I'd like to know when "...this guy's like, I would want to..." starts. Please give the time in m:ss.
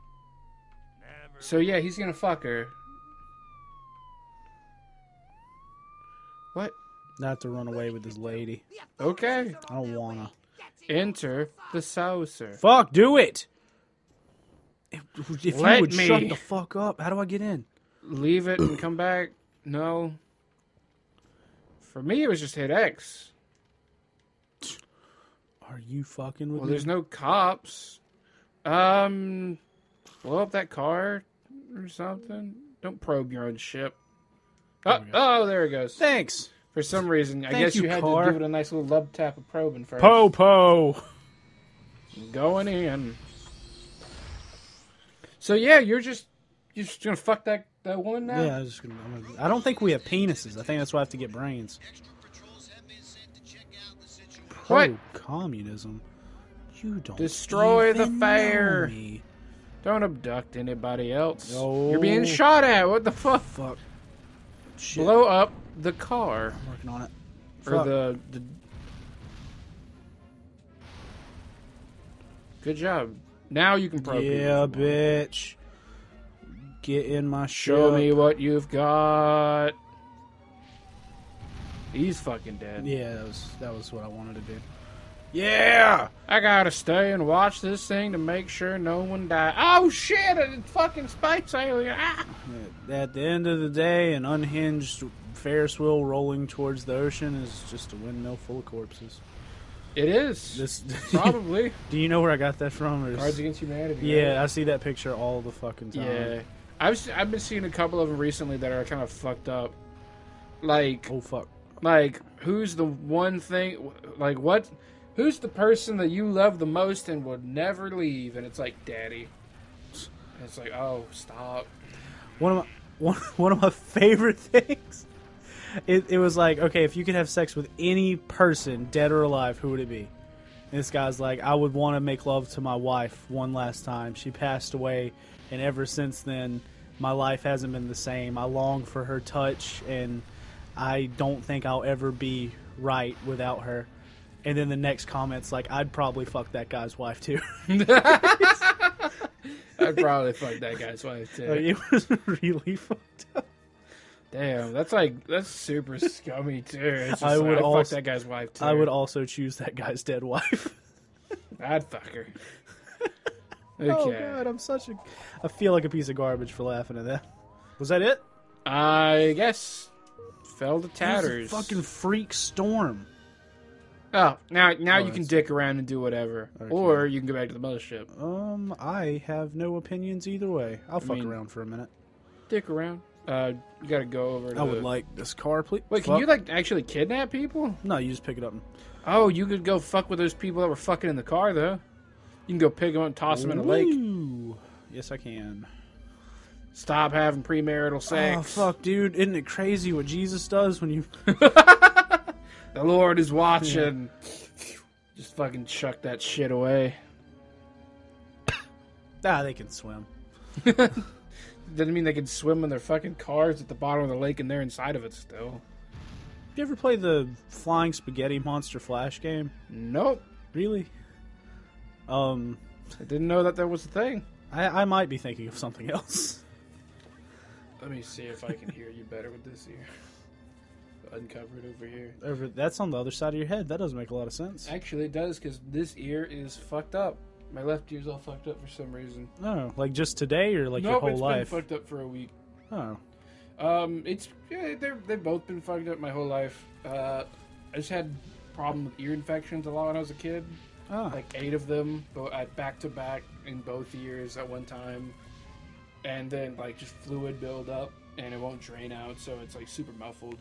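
2:10.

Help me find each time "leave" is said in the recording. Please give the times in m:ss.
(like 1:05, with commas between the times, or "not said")
0:18, 1:57.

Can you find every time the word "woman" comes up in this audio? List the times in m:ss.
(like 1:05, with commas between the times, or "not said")
0:48.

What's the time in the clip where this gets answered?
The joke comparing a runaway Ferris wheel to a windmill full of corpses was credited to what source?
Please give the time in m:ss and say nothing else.
1:43.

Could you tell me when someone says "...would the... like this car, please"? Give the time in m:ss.
3:04.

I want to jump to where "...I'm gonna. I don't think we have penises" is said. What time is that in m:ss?
0:49.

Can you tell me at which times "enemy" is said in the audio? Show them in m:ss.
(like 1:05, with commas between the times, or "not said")
not said.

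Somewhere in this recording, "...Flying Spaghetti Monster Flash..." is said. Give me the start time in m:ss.
3:37.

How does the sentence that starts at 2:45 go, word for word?
I feel like a piece of garbage for laughing at that.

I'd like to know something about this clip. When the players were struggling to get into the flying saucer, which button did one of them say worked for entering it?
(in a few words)
X.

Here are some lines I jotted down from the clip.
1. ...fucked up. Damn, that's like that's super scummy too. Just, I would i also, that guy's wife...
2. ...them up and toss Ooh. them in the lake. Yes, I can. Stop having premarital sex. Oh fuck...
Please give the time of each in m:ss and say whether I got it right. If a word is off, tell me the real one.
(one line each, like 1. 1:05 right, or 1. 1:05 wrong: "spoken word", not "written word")
1. 2:32 right
2. 3:12 right.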